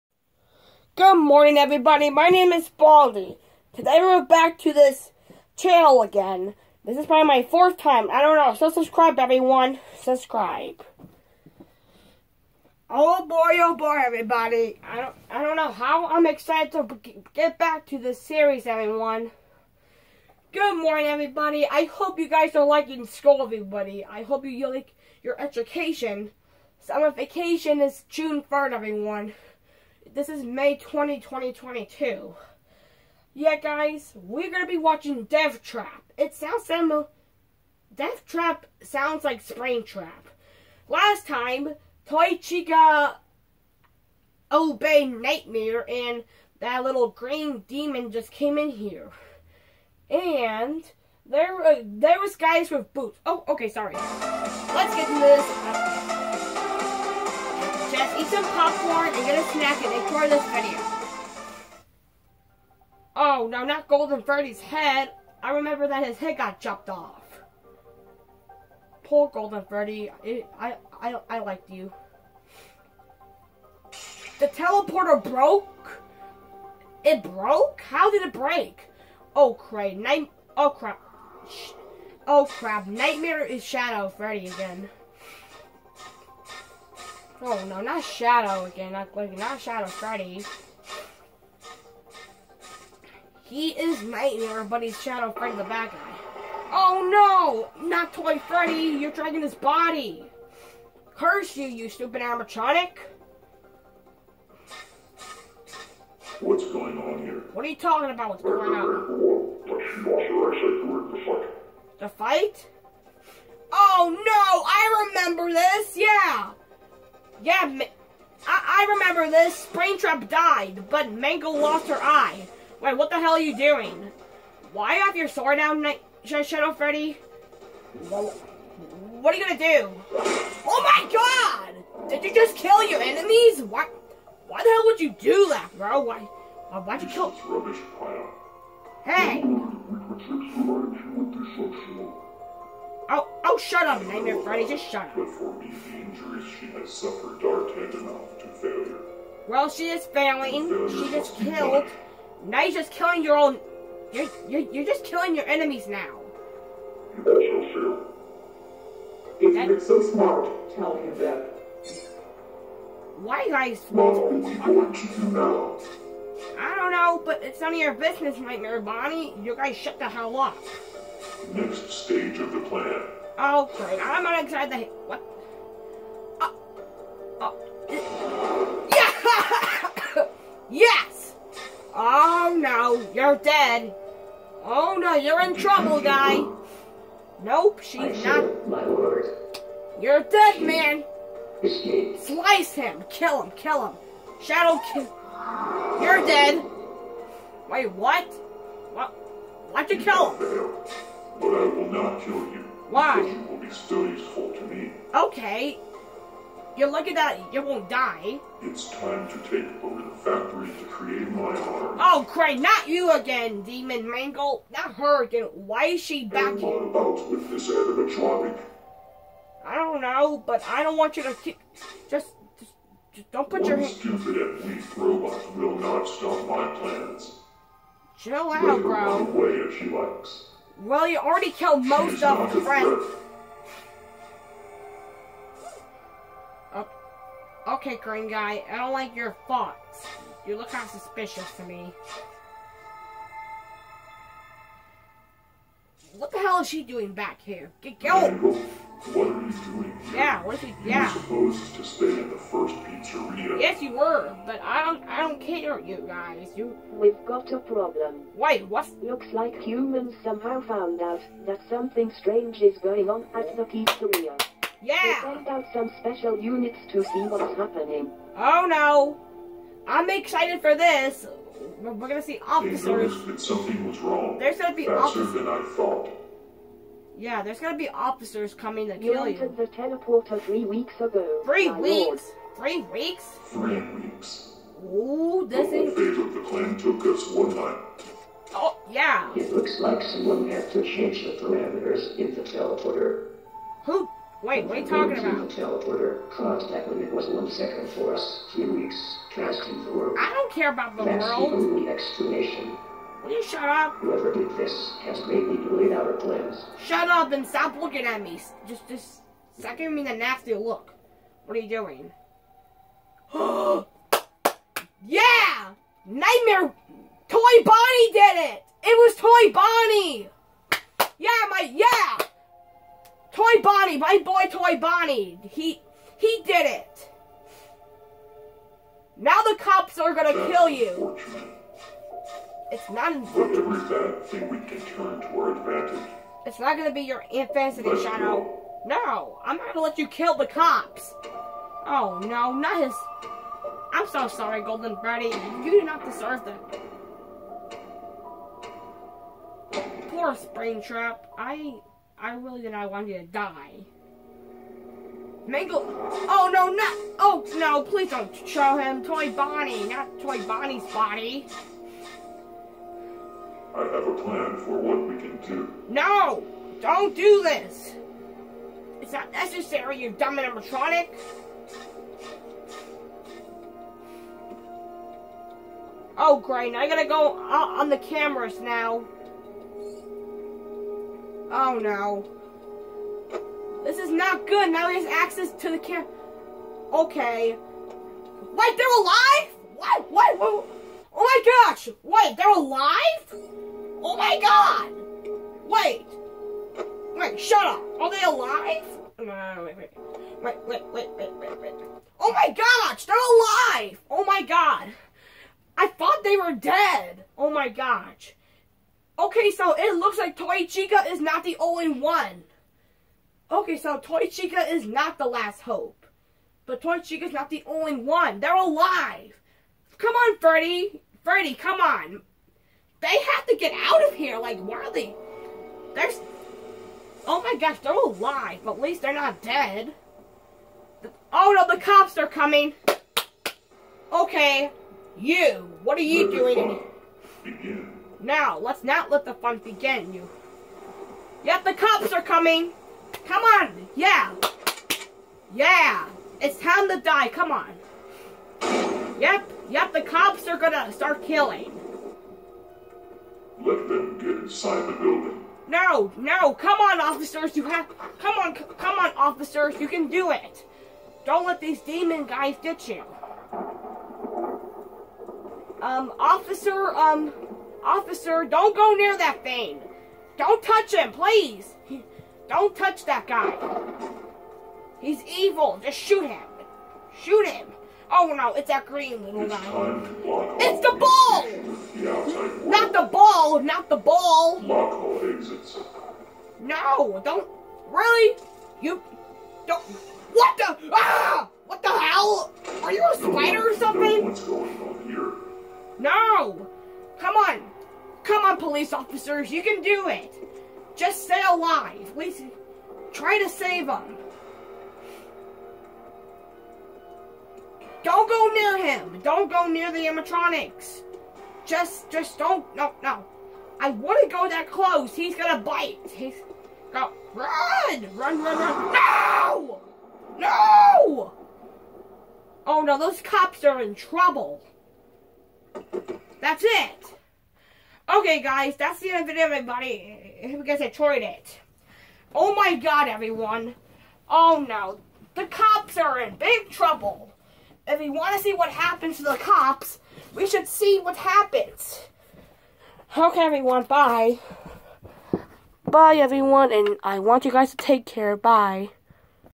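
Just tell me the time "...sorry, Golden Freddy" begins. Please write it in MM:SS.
05:44.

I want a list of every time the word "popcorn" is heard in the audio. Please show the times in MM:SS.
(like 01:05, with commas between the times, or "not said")
00:58.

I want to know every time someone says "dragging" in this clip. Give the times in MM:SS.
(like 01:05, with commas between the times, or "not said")
01:39.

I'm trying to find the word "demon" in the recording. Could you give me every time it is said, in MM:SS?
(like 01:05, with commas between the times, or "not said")
00:47, 03:33, 07:41.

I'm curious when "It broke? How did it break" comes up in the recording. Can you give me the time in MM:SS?
01:17.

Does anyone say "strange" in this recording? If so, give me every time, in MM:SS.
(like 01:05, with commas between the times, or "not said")
04:22.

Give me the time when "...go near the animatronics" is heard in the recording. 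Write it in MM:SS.
08:29.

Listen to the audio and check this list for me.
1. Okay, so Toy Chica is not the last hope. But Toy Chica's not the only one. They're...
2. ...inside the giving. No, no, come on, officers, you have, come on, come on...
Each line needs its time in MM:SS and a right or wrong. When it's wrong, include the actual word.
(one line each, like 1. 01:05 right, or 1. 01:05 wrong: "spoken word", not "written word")
1. 06:53 right
2. 07:34 wrong: "building", not "giving".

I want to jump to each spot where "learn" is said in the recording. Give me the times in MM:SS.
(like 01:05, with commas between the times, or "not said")
not said.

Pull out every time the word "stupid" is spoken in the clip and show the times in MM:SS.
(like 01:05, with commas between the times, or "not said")
01:41, 03:43.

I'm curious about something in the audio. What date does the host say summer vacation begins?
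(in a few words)
June 3rd.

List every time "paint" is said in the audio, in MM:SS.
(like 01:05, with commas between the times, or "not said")
not said.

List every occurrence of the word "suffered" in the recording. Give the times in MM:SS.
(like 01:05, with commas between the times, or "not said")
02:26.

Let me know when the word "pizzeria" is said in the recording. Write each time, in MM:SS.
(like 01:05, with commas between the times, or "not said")
04:12, 04:23.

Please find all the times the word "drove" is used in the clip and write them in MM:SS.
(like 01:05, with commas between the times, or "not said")
not said.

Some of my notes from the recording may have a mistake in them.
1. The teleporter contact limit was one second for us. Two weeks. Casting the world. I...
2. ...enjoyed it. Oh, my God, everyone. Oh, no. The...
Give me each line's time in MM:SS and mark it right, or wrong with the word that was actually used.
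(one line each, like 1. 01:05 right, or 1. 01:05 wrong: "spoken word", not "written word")
1. 04:55 wrong: "Three", not "Two"
2. 08:50 right.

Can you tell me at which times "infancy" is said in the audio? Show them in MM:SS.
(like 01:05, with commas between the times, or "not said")
05:37.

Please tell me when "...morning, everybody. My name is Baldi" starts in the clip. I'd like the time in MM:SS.
00:01.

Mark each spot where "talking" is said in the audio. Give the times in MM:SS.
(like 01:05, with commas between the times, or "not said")
01:47, 04:54.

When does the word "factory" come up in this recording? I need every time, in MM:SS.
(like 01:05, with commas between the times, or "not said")
03:30.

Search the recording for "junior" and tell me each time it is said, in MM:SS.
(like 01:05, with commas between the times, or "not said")
not said.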